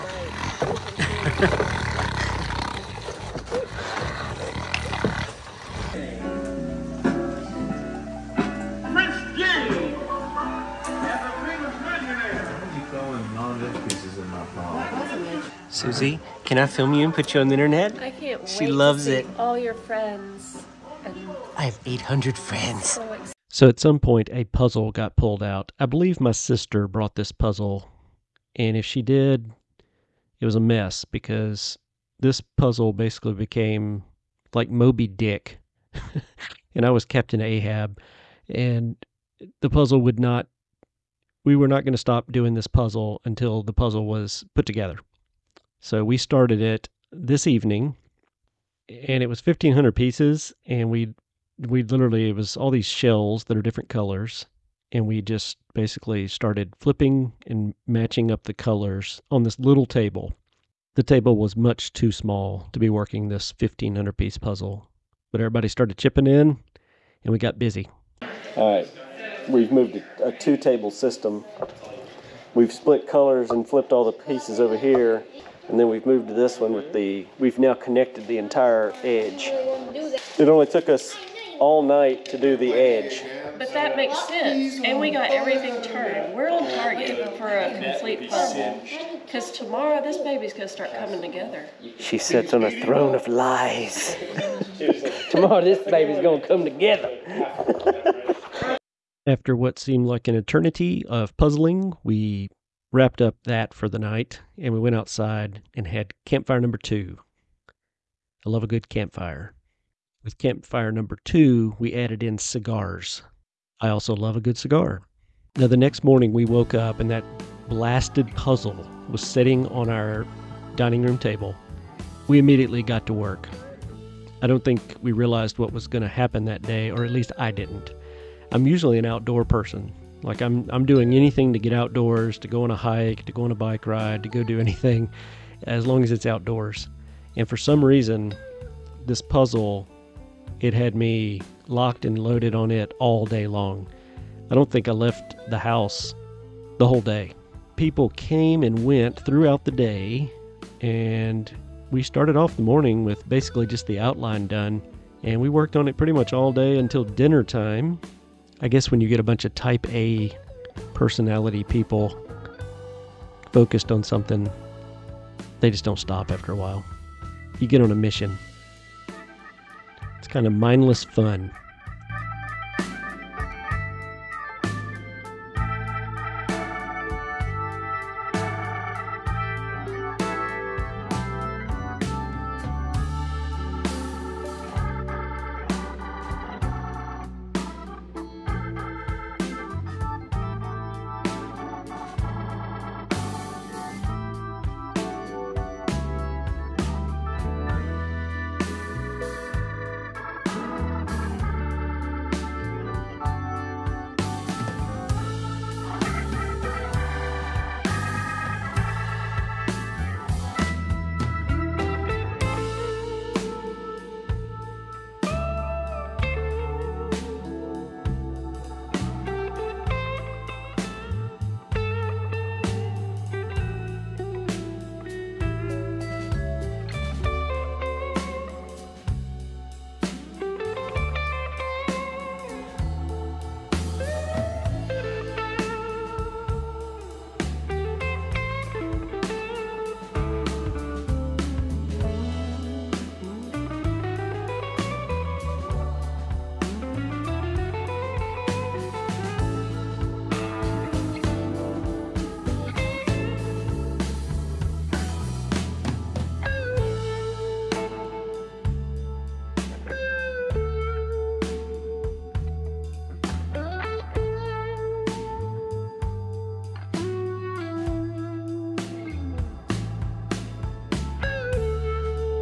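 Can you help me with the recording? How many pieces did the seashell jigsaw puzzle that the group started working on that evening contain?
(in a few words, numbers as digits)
1500.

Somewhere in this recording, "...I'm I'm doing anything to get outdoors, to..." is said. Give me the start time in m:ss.
2:10.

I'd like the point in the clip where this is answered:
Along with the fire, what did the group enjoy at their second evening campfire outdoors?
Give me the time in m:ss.
1:52.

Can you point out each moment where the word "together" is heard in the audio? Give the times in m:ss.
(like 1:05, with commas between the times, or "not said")
0:44, 1:31, 1:36.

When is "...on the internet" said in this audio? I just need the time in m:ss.
0:17.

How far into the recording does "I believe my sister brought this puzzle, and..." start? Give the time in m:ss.
0:25.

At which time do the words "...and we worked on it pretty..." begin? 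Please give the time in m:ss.
2:35.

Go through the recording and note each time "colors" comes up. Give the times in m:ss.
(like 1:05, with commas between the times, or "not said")
0:53, 0:58, 1:13.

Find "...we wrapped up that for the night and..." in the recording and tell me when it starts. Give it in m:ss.
1:42.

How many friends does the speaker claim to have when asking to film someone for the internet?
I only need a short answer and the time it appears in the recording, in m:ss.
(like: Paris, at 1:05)
800, at 0:21.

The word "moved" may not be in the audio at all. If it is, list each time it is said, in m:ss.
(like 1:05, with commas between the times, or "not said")
1:09, 1:16.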